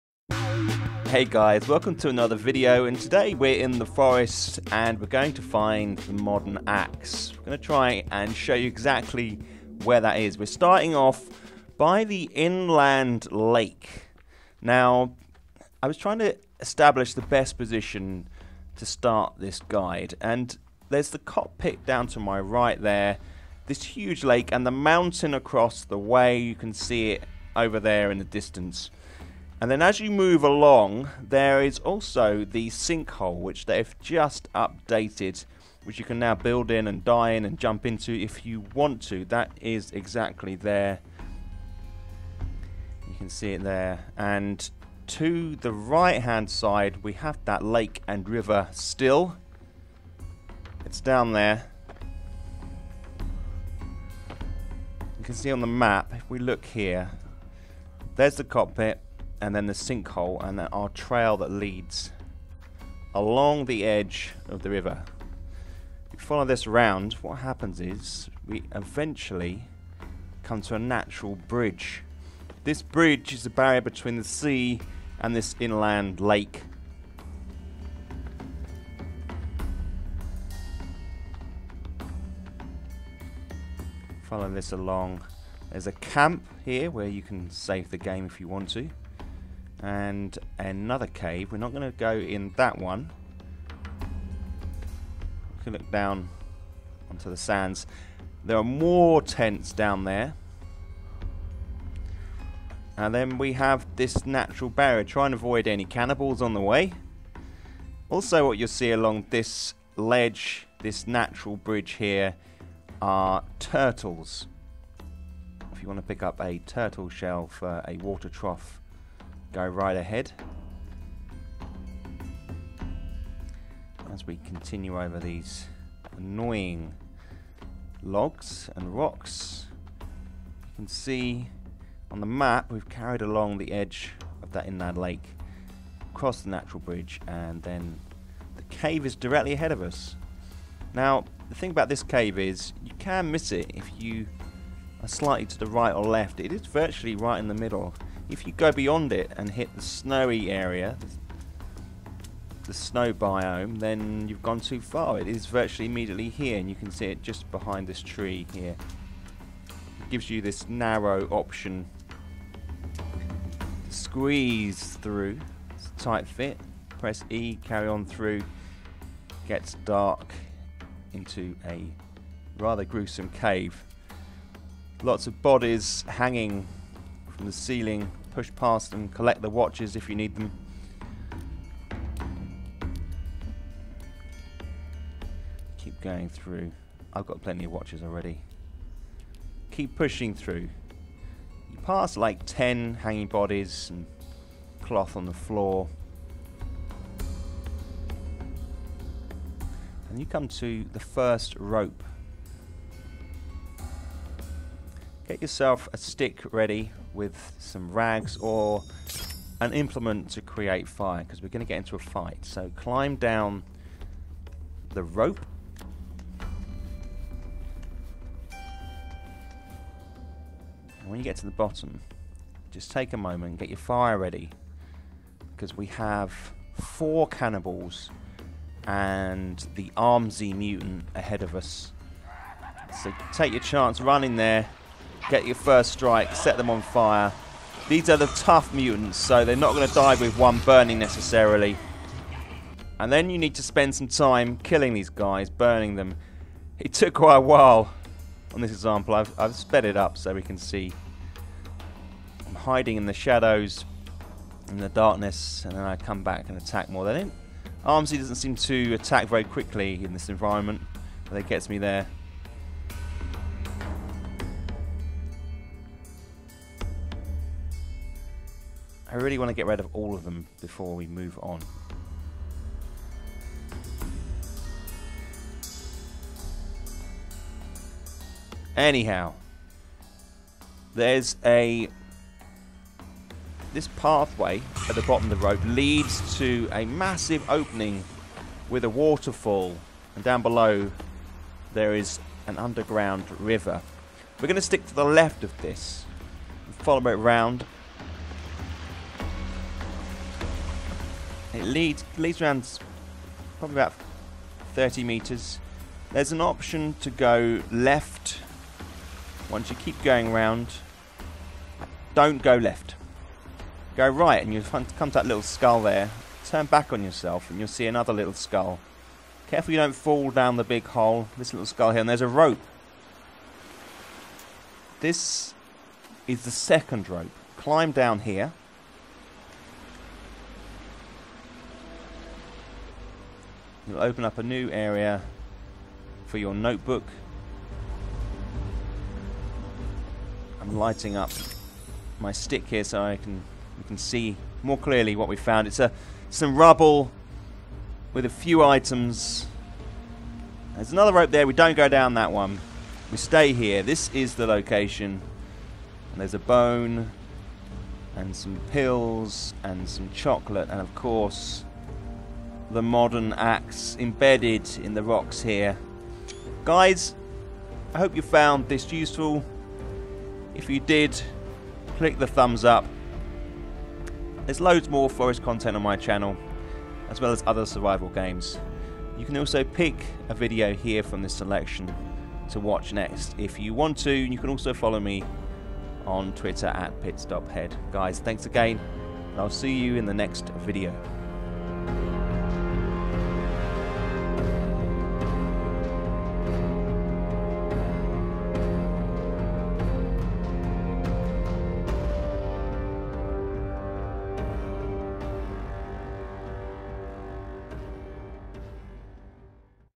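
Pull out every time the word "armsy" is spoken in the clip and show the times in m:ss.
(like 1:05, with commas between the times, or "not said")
3:49, 4:17.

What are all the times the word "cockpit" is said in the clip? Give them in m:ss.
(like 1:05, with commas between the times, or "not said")
0:21, 0:58.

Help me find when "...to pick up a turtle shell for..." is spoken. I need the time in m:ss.
1:55.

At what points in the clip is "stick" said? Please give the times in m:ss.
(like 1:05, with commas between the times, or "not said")
3:25, 4:54, 5:42.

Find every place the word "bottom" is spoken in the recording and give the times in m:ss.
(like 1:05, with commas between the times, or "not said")
3:41, 4:45.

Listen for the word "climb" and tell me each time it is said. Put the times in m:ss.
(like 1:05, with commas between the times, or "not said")
3:32, 5:27.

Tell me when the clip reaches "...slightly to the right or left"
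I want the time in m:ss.
2:25.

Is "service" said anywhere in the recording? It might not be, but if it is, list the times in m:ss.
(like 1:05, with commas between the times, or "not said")
not said.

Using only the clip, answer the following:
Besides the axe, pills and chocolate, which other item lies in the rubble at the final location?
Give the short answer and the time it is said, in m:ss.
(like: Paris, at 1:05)
bone, at 5:56.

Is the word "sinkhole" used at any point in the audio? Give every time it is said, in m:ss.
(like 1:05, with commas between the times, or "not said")
0:32, 0:59.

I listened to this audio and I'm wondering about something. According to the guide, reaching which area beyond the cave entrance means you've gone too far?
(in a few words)
snow biome.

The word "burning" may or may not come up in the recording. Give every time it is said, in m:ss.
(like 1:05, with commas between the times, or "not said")
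4:00, 4:05.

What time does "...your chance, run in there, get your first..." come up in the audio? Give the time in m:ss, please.
3:53.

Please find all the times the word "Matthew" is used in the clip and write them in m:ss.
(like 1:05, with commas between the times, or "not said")
not said.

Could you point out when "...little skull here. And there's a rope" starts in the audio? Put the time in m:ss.
5:21.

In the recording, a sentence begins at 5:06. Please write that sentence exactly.
There's an option to go left.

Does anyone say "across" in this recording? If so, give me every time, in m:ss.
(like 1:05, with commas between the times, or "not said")
0:25, 2:16.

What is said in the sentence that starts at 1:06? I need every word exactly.
If you follow this round, what happens is we eventually come to a natural bridge.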